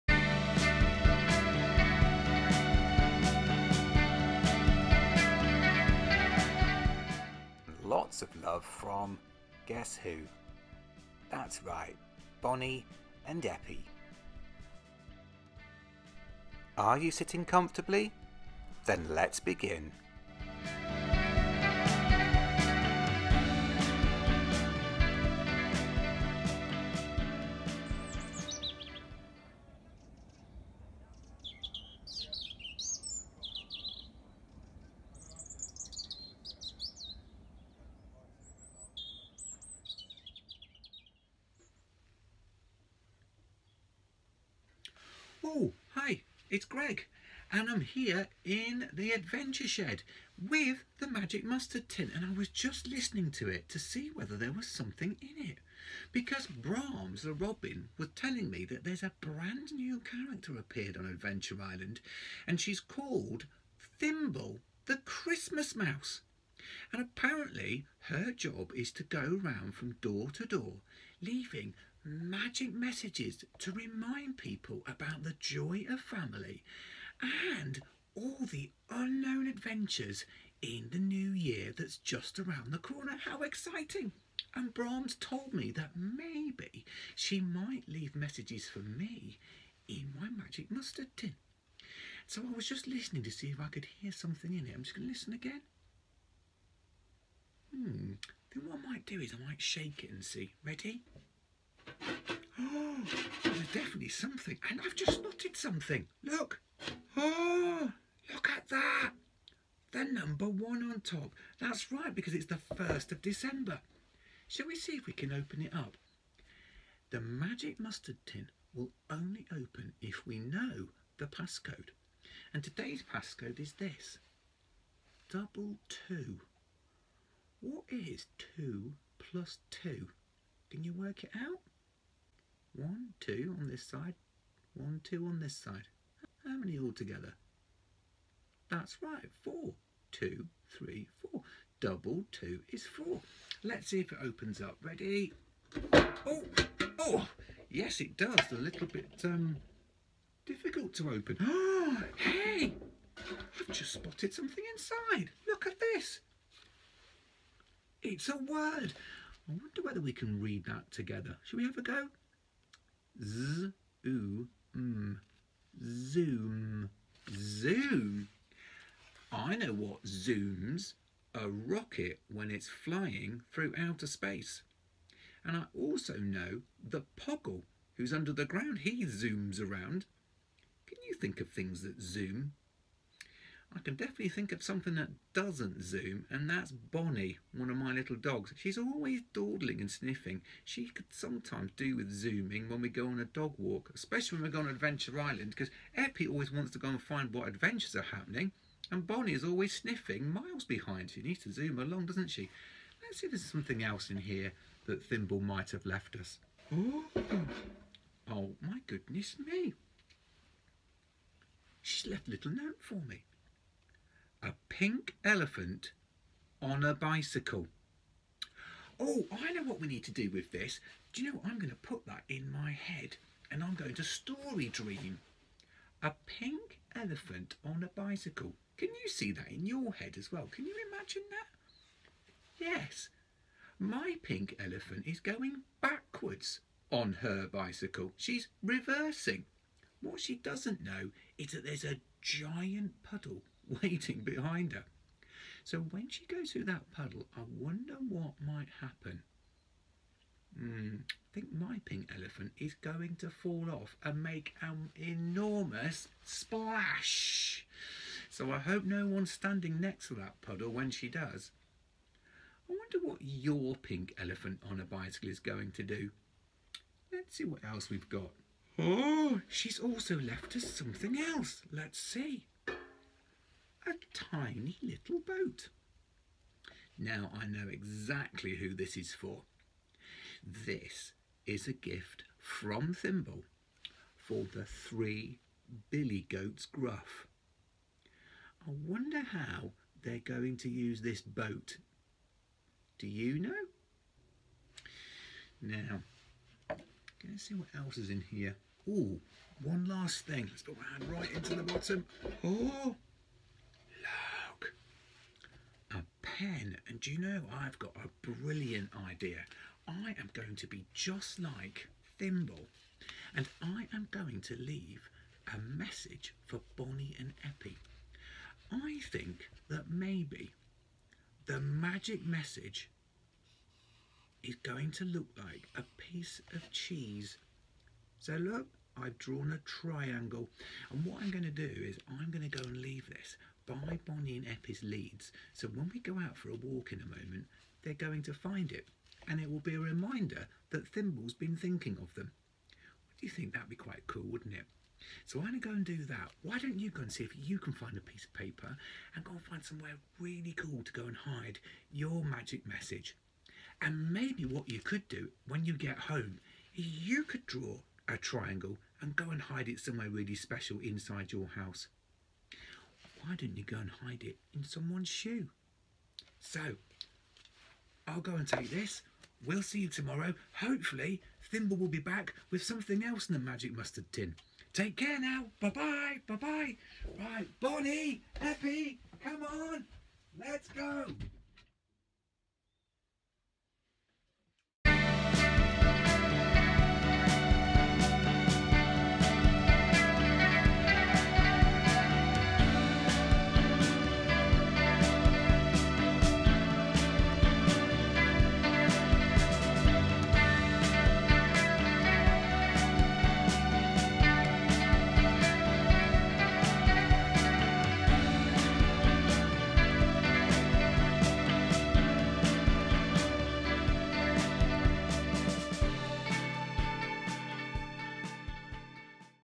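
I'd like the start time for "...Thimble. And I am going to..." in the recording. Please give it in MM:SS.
05:12.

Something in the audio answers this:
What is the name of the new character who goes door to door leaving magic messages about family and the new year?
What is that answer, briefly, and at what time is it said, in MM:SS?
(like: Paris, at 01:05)
Thimble the Christmas Mouse, at 01:03.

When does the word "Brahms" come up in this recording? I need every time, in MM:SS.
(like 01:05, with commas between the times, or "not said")
00:56, 01:24.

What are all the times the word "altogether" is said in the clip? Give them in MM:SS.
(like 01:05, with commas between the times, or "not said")
02:16.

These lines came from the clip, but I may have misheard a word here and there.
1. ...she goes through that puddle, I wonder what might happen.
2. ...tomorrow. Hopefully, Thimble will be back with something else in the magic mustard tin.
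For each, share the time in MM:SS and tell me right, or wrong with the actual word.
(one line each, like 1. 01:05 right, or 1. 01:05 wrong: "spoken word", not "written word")
1. 04:06 right
2. 06:09 right.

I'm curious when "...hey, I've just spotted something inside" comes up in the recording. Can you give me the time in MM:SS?
02:32.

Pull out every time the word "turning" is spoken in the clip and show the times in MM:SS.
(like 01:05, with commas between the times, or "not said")
not said.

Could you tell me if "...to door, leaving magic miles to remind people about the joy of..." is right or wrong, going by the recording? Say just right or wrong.
wrong.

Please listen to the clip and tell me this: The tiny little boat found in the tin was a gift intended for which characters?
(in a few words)
the three billy goats gruff.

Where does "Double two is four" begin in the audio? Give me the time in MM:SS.
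02:21.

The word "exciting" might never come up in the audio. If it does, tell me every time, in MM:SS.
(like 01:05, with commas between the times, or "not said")
01:23.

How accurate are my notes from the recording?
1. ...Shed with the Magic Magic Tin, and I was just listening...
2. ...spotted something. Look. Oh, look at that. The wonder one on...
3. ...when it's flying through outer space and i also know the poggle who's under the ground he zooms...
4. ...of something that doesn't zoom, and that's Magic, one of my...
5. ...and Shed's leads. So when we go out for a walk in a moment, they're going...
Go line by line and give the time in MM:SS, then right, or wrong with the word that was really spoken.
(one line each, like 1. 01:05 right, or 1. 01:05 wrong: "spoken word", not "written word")
1. 00:49 wrong: "Mustard", not "Magic"
2. 01:45 wrong: "number", not "wonder"
3. 02:52 right
4. 03:04 wrong: "Bonnie", not "Magic"
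5. 05:34 wrong: "Eppie", not "Shed".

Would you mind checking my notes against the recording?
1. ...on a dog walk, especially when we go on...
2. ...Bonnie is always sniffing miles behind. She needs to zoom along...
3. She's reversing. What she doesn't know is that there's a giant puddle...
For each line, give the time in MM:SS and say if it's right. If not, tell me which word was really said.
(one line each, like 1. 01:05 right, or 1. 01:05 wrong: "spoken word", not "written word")
1. 03:13 right
2. 03:19 right
3. 03:58 right.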